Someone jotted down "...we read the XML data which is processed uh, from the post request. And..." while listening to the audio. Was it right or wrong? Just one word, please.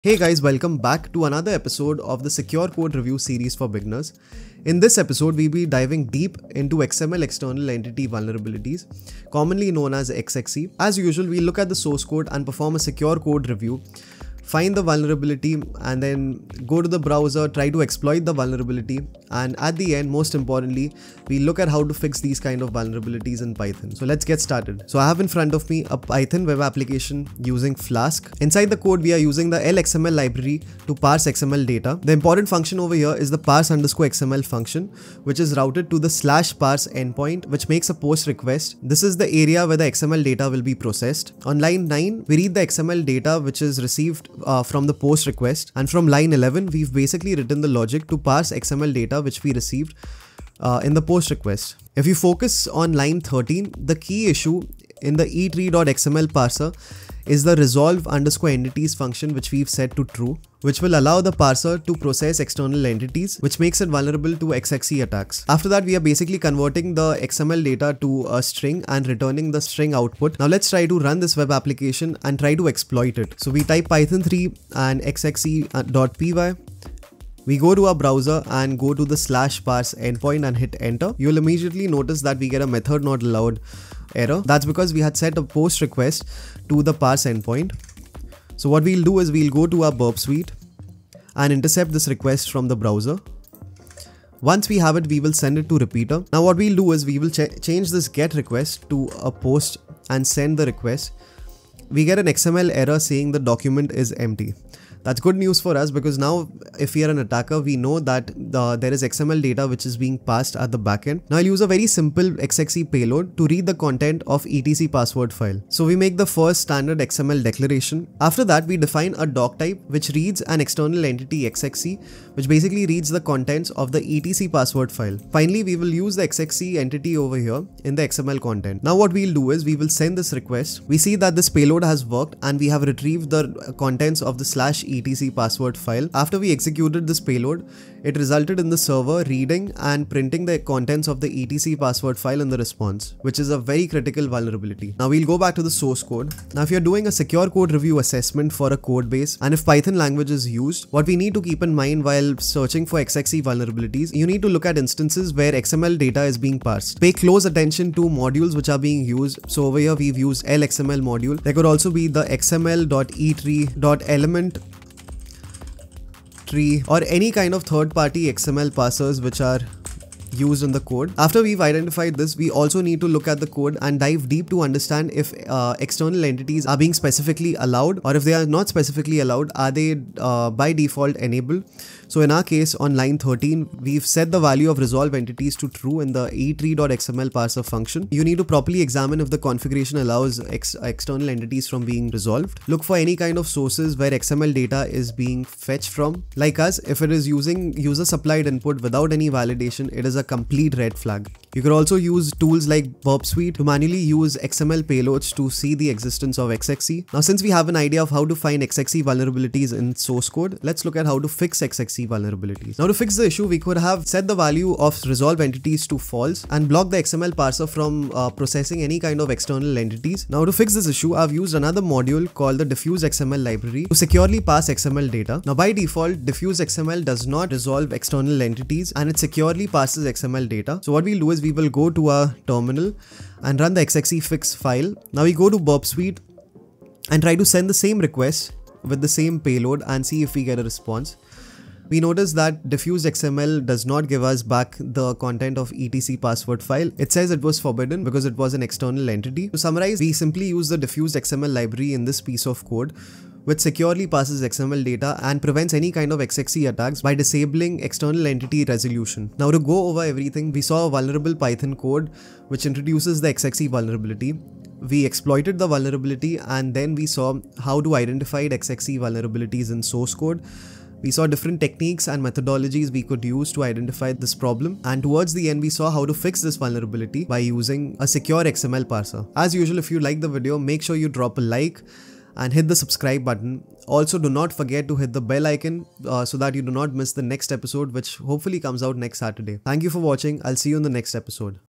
wrong.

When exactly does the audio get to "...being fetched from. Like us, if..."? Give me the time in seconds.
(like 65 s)
195 s.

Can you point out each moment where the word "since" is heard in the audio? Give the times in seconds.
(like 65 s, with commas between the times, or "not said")
207 s.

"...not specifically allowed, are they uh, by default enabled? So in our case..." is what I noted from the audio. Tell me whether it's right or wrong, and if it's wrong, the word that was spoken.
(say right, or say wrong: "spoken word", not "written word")
right.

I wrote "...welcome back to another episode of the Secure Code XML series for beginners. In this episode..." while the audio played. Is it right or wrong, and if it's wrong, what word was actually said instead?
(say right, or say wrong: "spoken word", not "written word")
wrong: "Review", not "XML".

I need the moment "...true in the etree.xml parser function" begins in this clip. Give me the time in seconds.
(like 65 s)
185 s.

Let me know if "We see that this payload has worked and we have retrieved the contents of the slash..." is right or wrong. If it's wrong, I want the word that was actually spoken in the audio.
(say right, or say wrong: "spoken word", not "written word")
right.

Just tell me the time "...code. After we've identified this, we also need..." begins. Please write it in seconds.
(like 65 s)
170 s.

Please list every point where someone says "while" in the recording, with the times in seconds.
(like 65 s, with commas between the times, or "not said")
152 s.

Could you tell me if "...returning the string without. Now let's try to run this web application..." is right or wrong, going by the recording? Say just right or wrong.
wrong.